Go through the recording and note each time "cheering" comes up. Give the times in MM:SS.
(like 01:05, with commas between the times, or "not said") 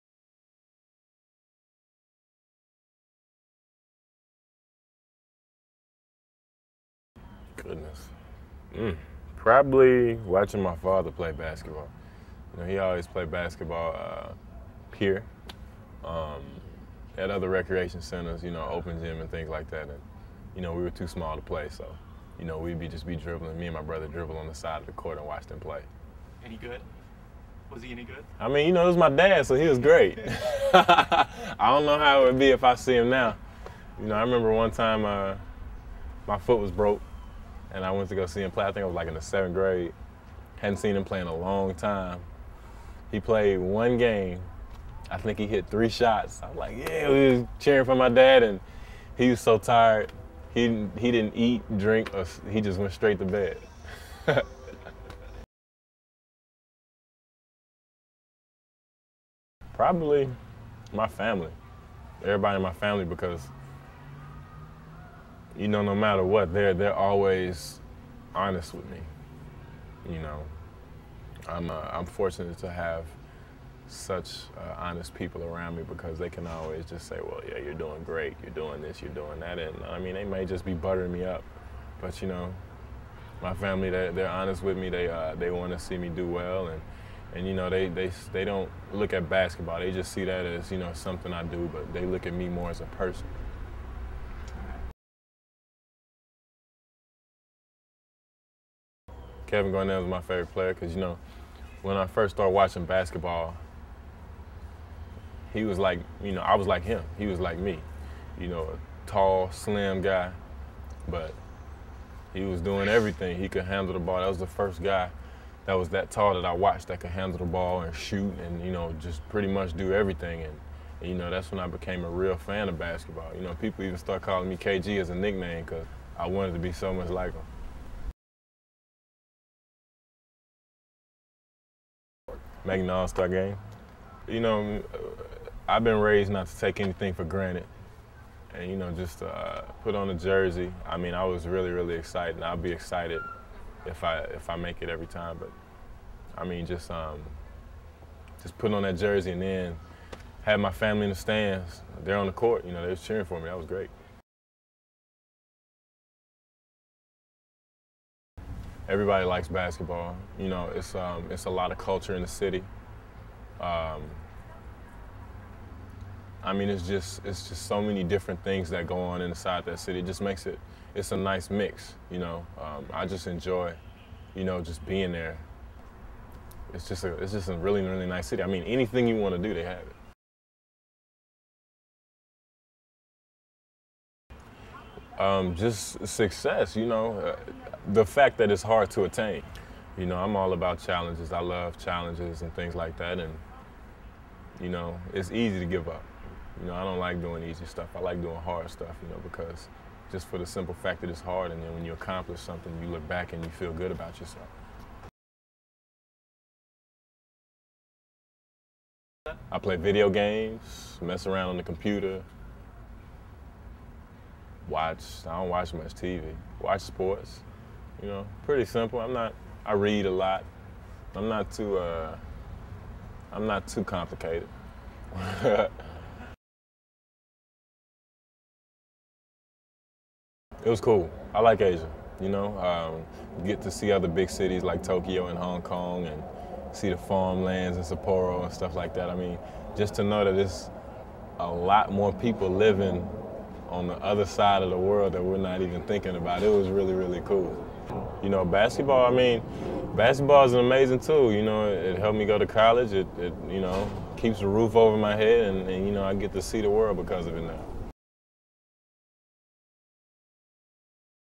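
00:47, 02:32.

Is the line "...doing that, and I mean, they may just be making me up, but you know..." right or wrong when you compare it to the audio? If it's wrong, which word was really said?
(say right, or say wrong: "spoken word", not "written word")
wrong: "buttering", not "making".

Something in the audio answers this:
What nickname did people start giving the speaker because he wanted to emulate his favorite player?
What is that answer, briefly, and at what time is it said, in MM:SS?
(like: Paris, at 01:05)
KG, at 02:04.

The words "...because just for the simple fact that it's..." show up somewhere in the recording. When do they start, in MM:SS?
03:19.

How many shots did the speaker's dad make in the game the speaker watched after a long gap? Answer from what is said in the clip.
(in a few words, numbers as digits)
3.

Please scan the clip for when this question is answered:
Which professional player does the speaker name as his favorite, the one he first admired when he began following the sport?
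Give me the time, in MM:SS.
01:39.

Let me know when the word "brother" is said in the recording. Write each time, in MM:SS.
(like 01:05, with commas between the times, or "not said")
00:23.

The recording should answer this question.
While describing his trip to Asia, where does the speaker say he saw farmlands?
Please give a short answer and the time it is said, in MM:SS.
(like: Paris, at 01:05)
Sapporo, at 03:57.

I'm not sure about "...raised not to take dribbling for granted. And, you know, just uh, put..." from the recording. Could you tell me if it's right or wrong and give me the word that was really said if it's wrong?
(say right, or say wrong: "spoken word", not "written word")
wrong: "anything", not "dribbling".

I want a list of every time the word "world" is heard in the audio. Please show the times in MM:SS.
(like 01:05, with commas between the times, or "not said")
04:04, 04:16.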